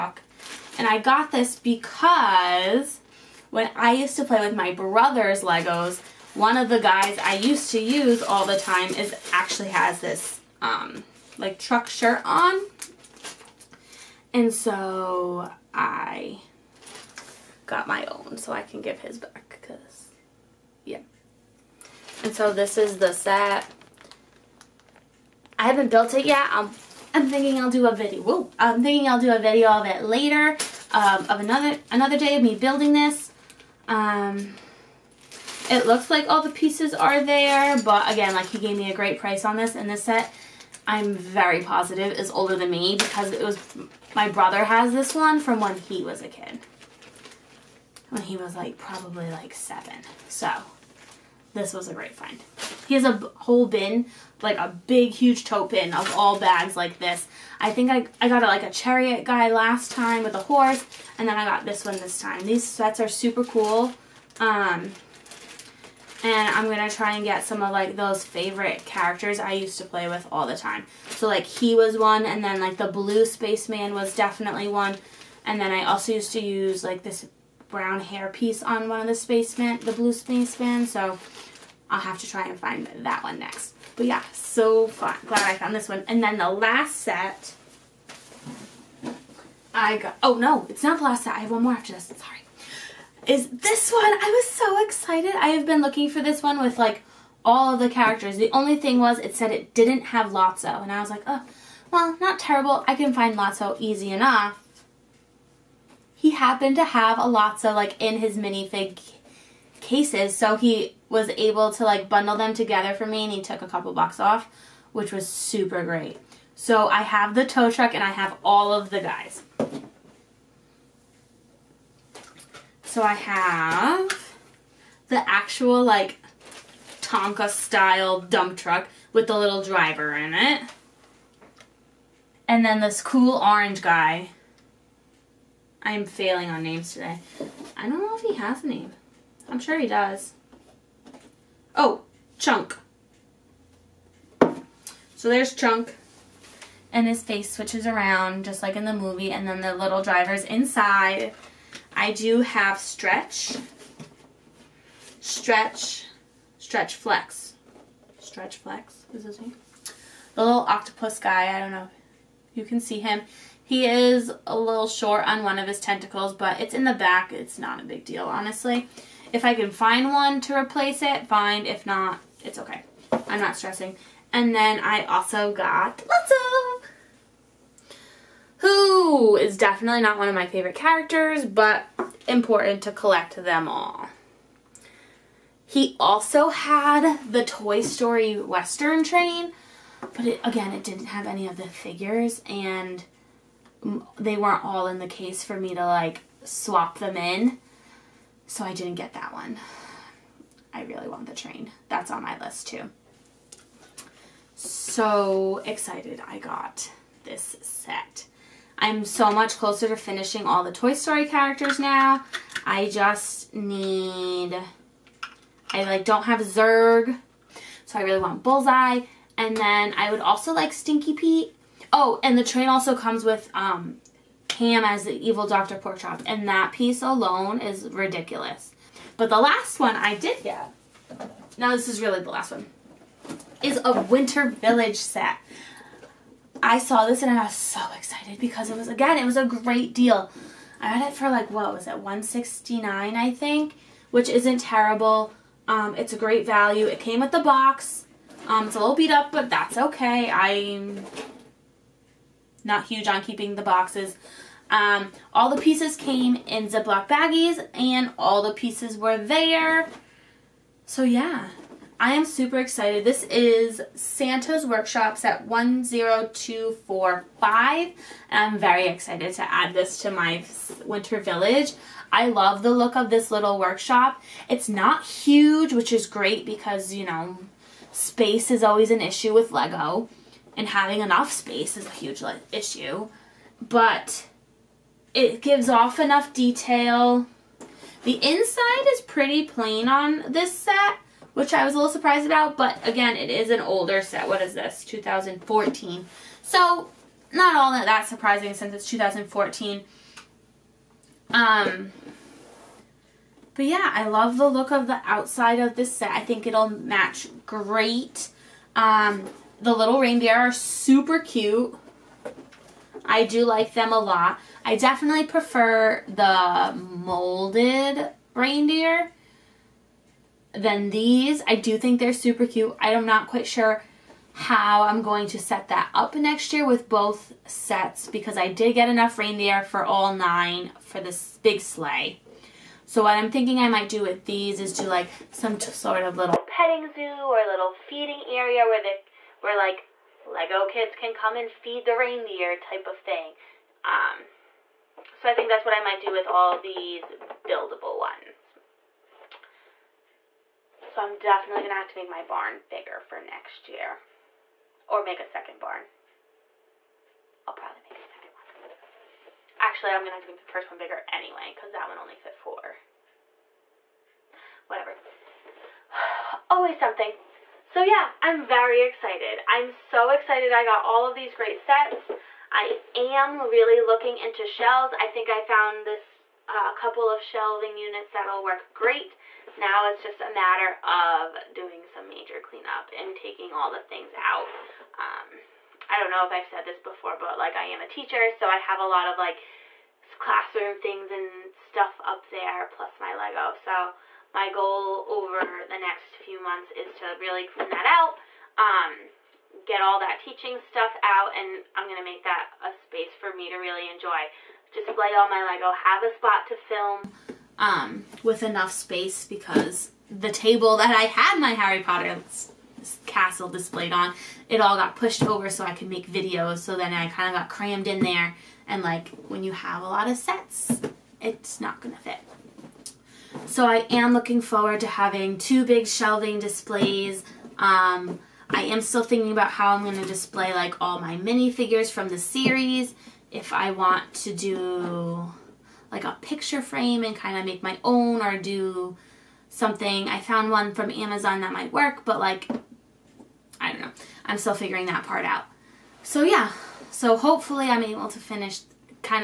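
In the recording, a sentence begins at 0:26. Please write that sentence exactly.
I'm, I'm thinking I'll do a video.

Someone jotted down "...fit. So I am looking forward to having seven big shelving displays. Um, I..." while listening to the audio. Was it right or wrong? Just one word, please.
wrong.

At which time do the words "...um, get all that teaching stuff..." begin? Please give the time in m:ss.
6:38.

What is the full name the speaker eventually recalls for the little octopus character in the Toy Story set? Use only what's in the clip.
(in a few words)
Stretch Flex.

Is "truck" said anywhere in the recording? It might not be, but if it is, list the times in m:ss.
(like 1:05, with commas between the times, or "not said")
0:11, 1:57, 2:08.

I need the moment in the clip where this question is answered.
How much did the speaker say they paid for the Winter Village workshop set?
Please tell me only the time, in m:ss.
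4:01.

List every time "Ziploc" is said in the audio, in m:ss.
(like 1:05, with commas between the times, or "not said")
4:16.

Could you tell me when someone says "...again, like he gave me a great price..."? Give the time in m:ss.
0:38.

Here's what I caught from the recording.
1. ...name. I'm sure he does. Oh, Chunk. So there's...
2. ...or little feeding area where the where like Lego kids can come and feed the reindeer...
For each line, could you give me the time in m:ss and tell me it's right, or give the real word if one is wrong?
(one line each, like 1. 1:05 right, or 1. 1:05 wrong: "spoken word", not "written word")
1. 2:18 right
2. 5:37 right.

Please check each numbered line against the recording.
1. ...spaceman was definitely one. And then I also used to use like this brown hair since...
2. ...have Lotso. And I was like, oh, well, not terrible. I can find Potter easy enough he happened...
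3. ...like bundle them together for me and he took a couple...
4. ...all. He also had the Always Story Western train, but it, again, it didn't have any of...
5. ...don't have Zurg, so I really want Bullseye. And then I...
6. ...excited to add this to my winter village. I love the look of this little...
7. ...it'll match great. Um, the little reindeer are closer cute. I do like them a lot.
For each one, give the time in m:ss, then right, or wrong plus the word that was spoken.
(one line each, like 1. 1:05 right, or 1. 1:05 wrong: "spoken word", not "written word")
1. 1:13 wrong: "piece", not "since"
2. 1:40 wrong: "Lotso", not "Potter"
3. 1:51 right
4. 3:03 wrong: "Toy", not "Always"
5. 3:36 right
6. 4:28 right
7. 5:06 wrong: "super", not "closer".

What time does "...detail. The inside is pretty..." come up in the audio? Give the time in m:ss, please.
4:46.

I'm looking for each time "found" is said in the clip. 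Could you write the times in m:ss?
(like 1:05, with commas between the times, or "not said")
1:25, 6:15, 7:20.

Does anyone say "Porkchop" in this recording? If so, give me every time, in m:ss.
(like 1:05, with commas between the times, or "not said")
3:45.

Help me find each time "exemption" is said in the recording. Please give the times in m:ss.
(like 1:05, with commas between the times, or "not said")
not said.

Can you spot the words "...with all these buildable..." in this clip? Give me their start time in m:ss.
5:46.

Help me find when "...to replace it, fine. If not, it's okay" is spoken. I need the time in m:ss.
2:50.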